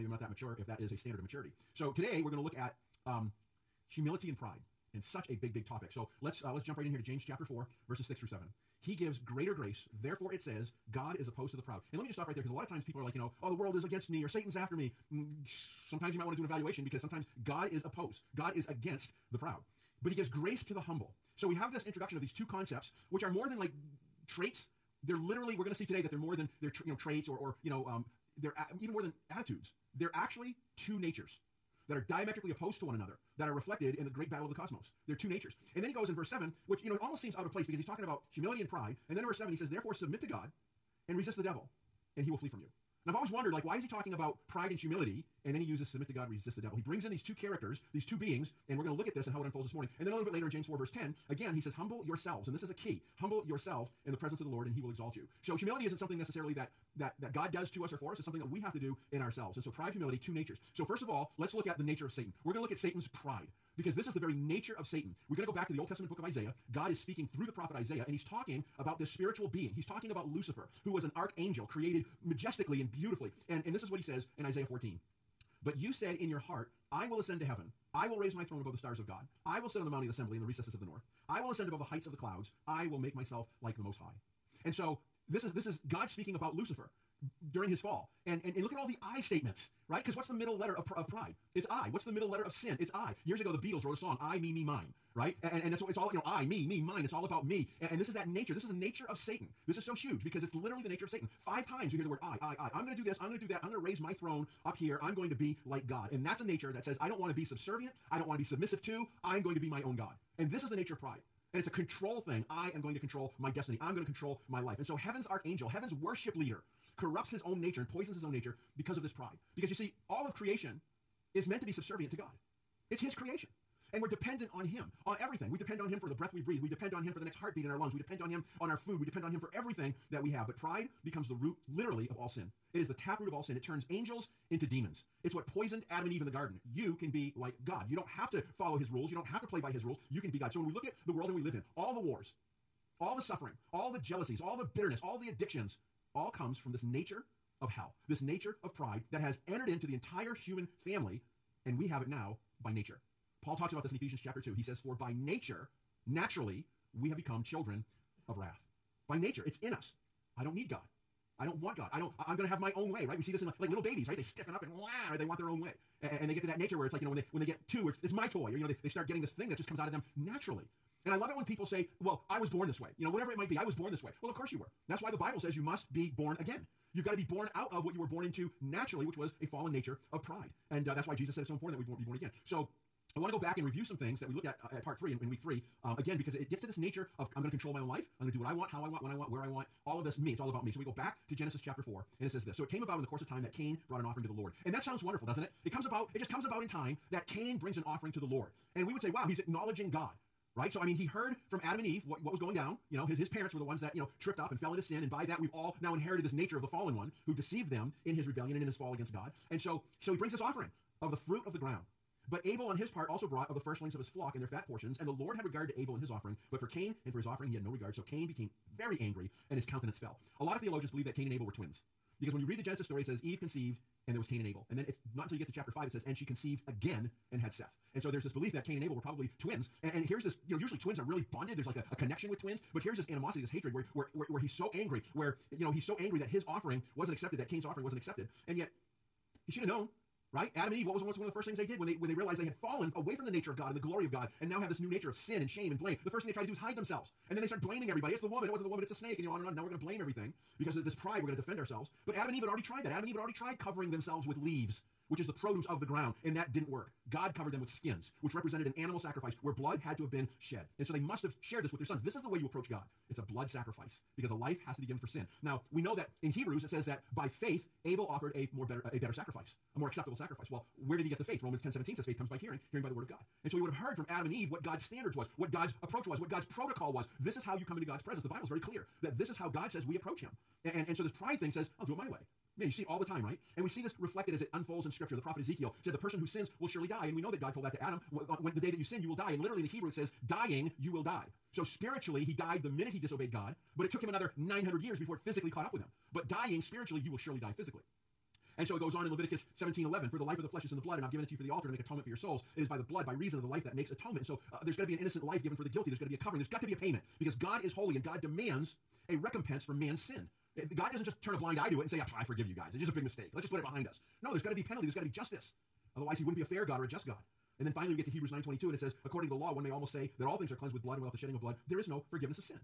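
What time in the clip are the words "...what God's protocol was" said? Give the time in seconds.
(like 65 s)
276 s.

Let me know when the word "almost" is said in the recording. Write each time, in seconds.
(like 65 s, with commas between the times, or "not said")
37 s, 319 s.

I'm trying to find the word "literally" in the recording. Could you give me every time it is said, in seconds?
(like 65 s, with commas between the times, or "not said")
25 s, 100 s, 131 s, 289 s.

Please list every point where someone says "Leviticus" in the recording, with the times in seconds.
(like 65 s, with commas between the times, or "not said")
299 s.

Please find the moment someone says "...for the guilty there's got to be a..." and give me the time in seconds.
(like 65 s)
305 s.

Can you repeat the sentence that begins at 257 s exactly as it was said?
God covered them with skins, which represented an animal sacrifice where blood had to have been shed.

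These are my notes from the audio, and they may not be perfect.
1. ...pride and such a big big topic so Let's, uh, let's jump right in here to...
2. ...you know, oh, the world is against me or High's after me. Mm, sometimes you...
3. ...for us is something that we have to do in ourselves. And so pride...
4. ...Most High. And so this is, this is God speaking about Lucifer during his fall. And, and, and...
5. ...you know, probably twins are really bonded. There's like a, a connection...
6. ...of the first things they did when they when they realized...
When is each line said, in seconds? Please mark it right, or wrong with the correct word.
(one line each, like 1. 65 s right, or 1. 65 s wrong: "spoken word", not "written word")
1. 4 s right
2. 13 s wrong: "Satan", not "High"
3. 57 s right
4. 83 s right
5. 230 s wrong: "usually", not "probably"
6. 241 s right.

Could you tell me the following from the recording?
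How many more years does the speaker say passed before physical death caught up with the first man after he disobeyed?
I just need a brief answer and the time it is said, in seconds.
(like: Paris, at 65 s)
900, at 294 s.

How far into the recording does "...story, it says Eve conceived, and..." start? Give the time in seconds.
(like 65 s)
222 s.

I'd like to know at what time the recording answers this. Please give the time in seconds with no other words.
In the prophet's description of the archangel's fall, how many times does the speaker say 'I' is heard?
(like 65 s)
101 s.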